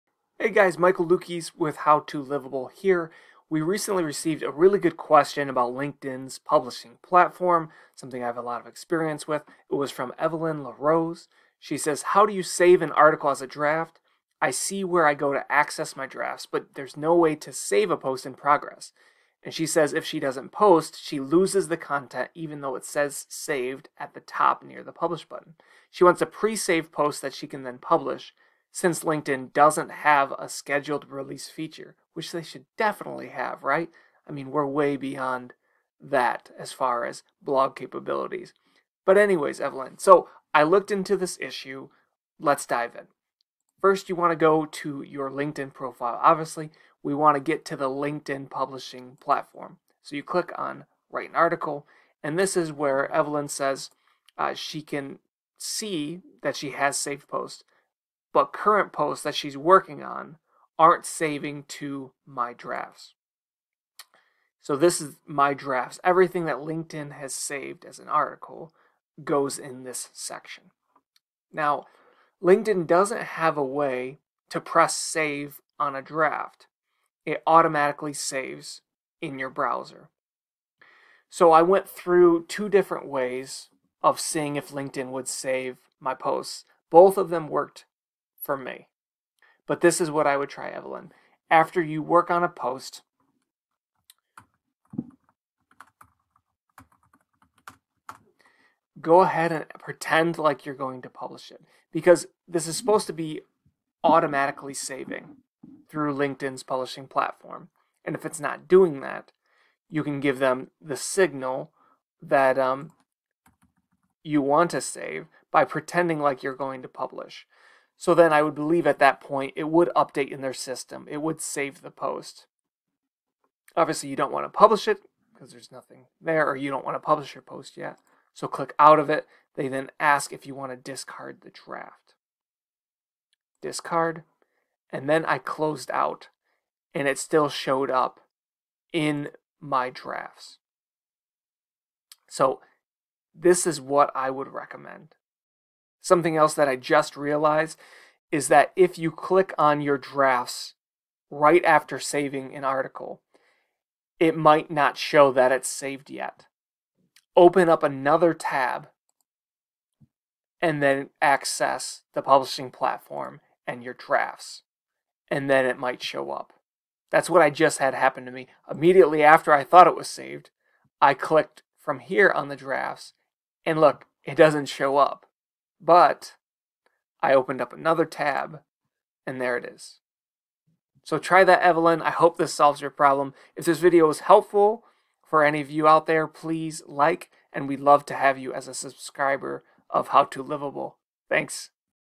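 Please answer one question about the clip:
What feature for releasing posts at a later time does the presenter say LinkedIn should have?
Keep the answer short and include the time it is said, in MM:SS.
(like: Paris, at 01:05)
scheduled release feature, at 00:30.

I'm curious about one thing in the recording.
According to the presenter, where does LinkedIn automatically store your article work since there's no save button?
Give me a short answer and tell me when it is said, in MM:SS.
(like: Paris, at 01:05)
in your browser, at 01:19.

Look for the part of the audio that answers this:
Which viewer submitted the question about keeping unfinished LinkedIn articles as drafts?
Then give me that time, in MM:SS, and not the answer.
00:10.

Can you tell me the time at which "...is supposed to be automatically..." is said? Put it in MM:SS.
01:42.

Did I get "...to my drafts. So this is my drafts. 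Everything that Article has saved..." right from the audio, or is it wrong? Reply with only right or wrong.
wrong.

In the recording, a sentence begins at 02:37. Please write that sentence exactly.
Open up another tab and then access the publishing platform and your drafts, and then it might show up.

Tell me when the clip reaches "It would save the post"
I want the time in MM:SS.
02:01.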